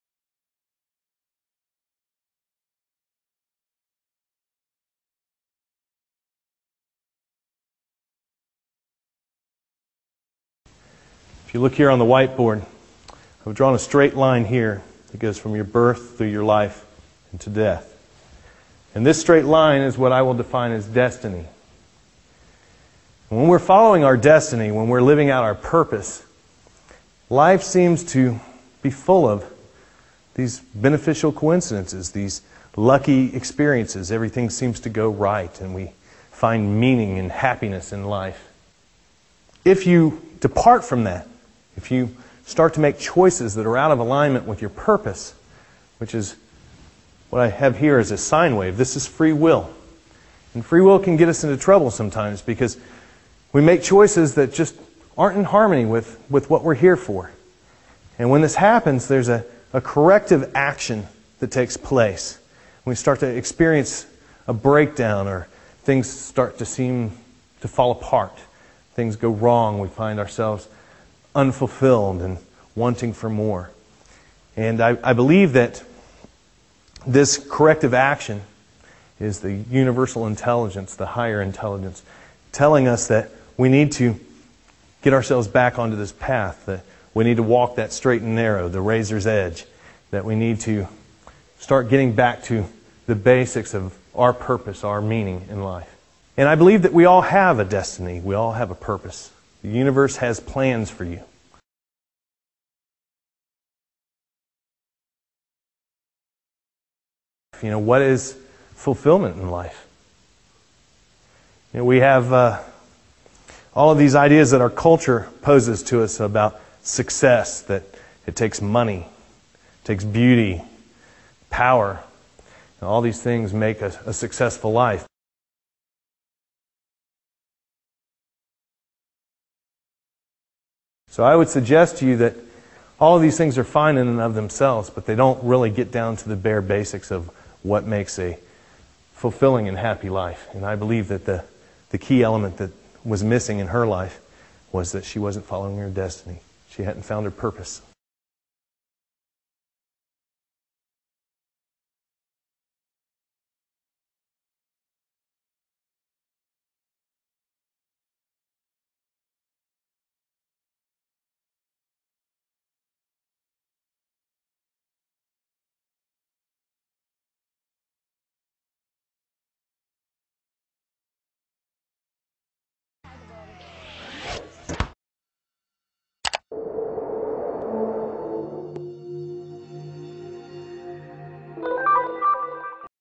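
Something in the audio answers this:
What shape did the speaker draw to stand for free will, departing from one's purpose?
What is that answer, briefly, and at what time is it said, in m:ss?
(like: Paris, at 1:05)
sine wave, at 0:48.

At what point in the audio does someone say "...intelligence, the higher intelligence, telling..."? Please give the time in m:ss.
1:20.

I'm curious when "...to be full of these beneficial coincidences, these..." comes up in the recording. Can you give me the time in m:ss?
0:28.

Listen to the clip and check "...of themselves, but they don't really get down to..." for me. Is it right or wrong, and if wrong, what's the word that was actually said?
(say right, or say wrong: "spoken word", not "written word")
right.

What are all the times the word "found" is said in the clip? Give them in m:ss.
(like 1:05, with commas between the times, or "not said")
2:27.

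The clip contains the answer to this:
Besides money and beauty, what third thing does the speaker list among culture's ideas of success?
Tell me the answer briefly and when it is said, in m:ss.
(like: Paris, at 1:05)
power, at 2:01.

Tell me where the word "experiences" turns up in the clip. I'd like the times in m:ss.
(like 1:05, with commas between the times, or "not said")
0:33, 1:03.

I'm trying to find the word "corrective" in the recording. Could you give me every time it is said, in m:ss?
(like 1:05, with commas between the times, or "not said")
0:59, 1:17.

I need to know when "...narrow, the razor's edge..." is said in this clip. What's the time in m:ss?
1:28.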